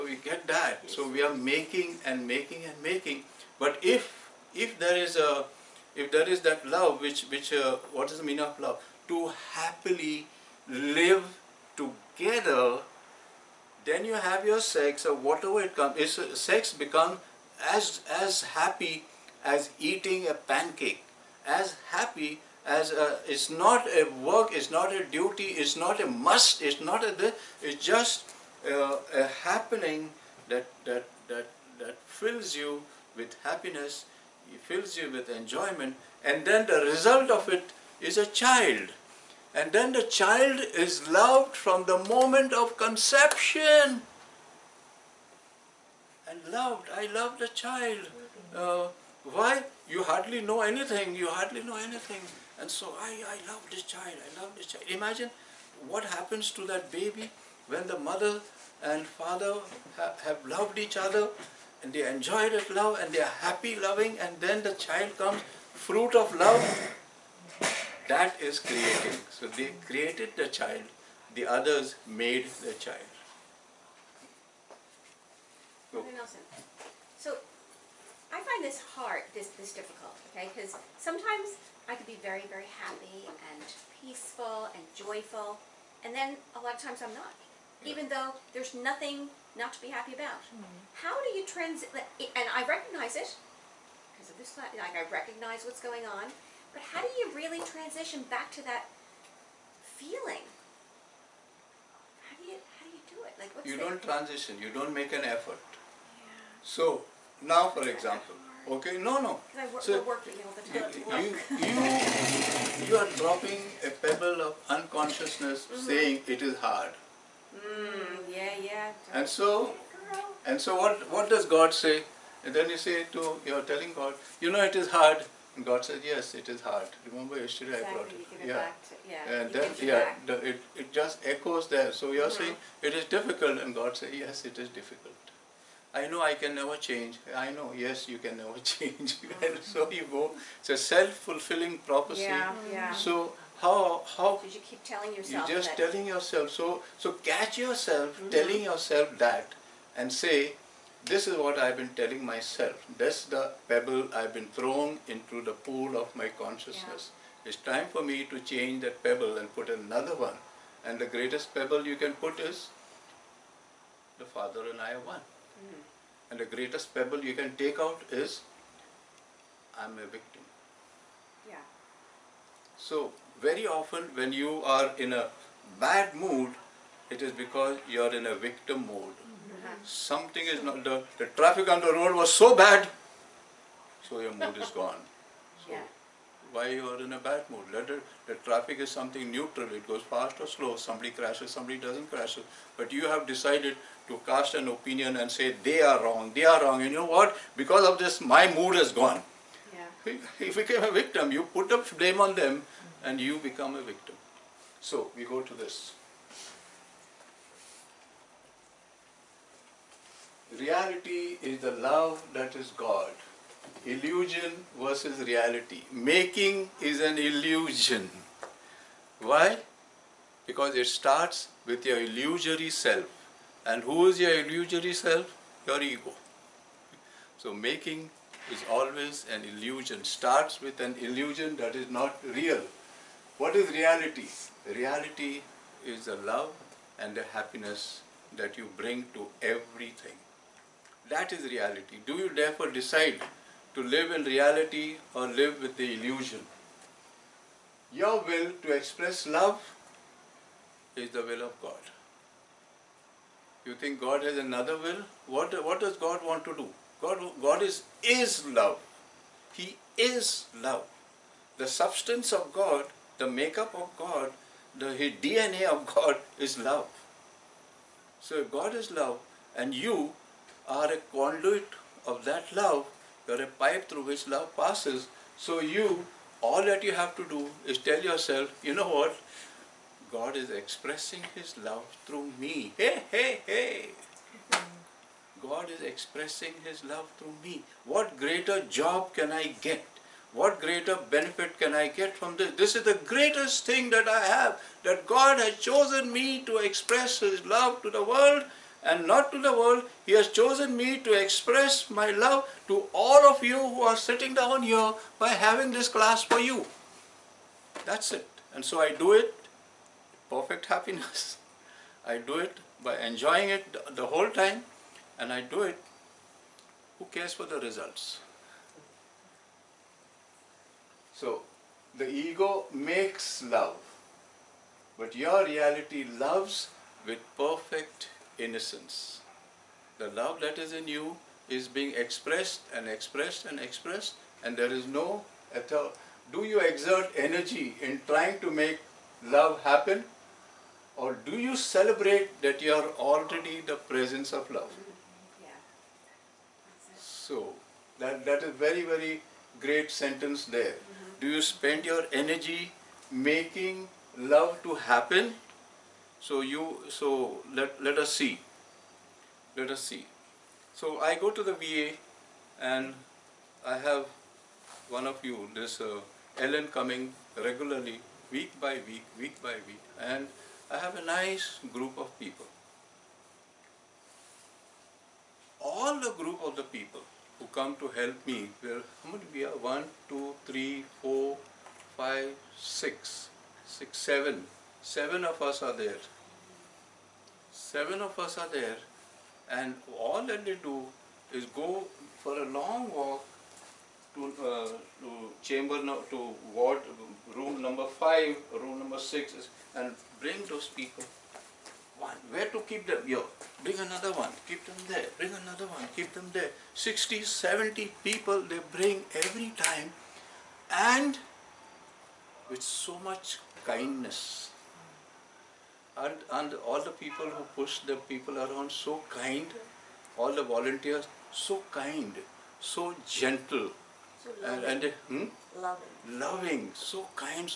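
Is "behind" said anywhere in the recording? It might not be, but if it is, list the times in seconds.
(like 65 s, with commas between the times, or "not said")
not said.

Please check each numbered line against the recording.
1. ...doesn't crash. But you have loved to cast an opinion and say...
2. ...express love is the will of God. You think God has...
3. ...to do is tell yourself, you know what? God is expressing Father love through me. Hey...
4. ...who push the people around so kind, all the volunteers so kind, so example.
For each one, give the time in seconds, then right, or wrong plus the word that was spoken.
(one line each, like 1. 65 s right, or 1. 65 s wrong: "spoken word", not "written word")
1. 191 s wrong: "decided", not "loved"
2. 248 s right
3. 277 s wrong: "His", not "Father"
4. 417 s wrong: "gentle", not "example".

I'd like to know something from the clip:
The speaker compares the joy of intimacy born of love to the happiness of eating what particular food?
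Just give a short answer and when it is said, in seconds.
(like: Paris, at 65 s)
A pancake, at 20 s.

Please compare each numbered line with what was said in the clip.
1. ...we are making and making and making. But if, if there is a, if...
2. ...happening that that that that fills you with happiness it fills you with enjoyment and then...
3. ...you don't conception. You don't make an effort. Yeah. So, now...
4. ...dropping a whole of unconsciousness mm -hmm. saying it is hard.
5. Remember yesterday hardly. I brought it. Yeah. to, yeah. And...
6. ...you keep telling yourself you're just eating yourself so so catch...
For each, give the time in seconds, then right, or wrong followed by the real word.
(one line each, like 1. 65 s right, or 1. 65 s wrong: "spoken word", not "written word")
1. 1 s right
2. 29 s right
3. 103 s wrong: "transition", not "conception"
4. 113 s wrong: "pebble", not "whole"
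5. 127 s wrong: "exactly", not "hardly"
6. 144 s wrong: "telling", not "eating".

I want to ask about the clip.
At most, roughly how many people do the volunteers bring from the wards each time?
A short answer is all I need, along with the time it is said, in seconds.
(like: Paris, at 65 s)
70, at 407 s.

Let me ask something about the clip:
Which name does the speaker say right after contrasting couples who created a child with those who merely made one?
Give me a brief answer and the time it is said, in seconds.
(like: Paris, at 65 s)
Nelson, at 75 s.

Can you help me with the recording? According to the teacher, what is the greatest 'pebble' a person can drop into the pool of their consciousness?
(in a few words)
The Father and I are one.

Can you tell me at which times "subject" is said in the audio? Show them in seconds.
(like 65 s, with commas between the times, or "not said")
not said.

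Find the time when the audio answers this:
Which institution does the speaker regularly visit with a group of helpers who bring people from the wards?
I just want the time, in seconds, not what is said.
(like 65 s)
361 s.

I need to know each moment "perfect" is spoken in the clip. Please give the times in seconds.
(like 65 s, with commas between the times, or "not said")
310 s, 327 s.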